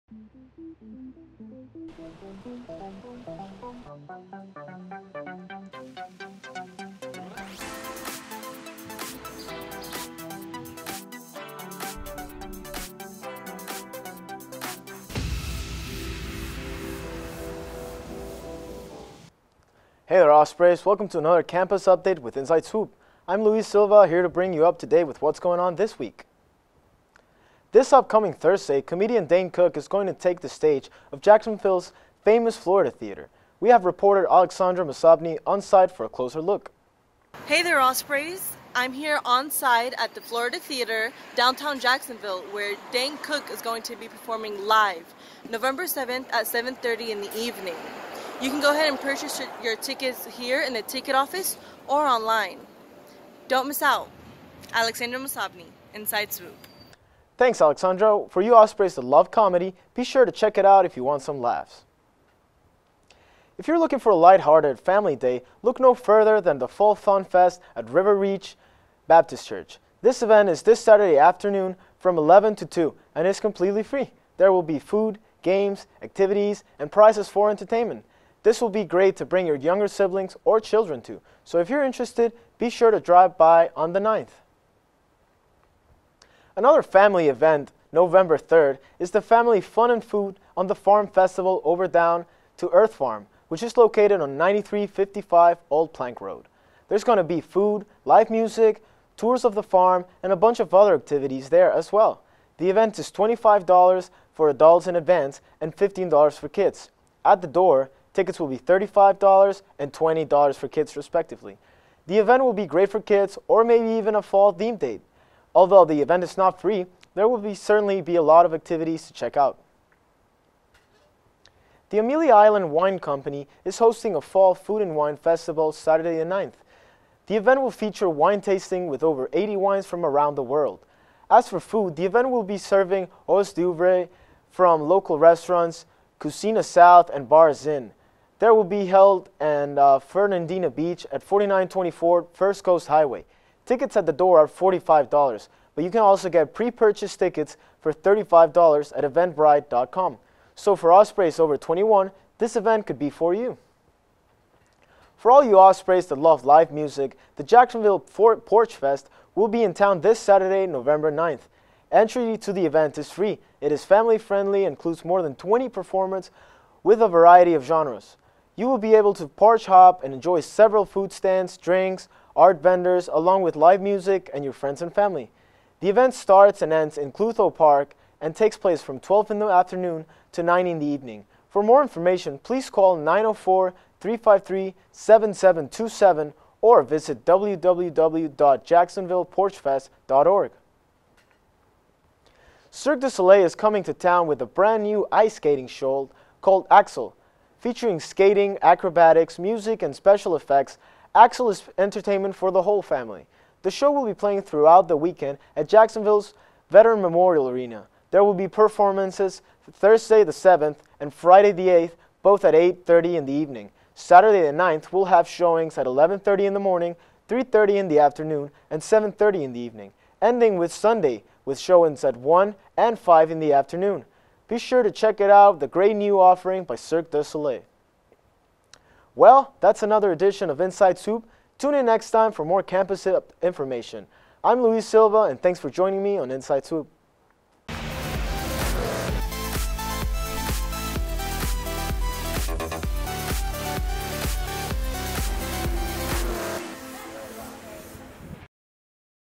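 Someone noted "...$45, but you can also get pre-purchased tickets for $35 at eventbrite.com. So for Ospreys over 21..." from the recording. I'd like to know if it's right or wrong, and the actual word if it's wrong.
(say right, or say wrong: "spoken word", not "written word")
right.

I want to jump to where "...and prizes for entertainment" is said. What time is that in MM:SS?
01:16.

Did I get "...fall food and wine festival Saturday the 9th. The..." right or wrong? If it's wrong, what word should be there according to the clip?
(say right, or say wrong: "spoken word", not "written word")
right.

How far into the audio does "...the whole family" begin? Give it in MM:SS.
03:22.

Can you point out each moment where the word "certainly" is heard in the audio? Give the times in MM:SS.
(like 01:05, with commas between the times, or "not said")
01:57.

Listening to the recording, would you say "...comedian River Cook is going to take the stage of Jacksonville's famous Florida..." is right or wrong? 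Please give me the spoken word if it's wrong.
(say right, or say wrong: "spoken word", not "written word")
wrong: "Dane", not "River".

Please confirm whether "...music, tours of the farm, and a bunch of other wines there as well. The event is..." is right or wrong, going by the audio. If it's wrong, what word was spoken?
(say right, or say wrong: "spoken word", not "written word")
wrong: "activities", not "wines".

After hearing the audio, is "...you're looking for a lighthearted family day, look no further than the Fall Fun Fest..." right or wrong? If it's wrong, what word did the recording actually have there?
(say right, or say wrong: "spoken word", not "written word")
right.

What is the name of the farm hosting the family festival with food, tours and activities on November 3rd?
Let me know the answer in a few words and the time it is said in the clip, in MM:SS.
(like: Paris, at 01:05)
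Down to Earth Farm, at 01:31.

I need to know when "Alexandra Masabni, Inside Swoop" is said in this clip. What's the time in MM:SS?
00:54.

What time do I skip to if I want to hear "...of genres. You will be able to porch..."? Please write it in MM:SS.
02:47.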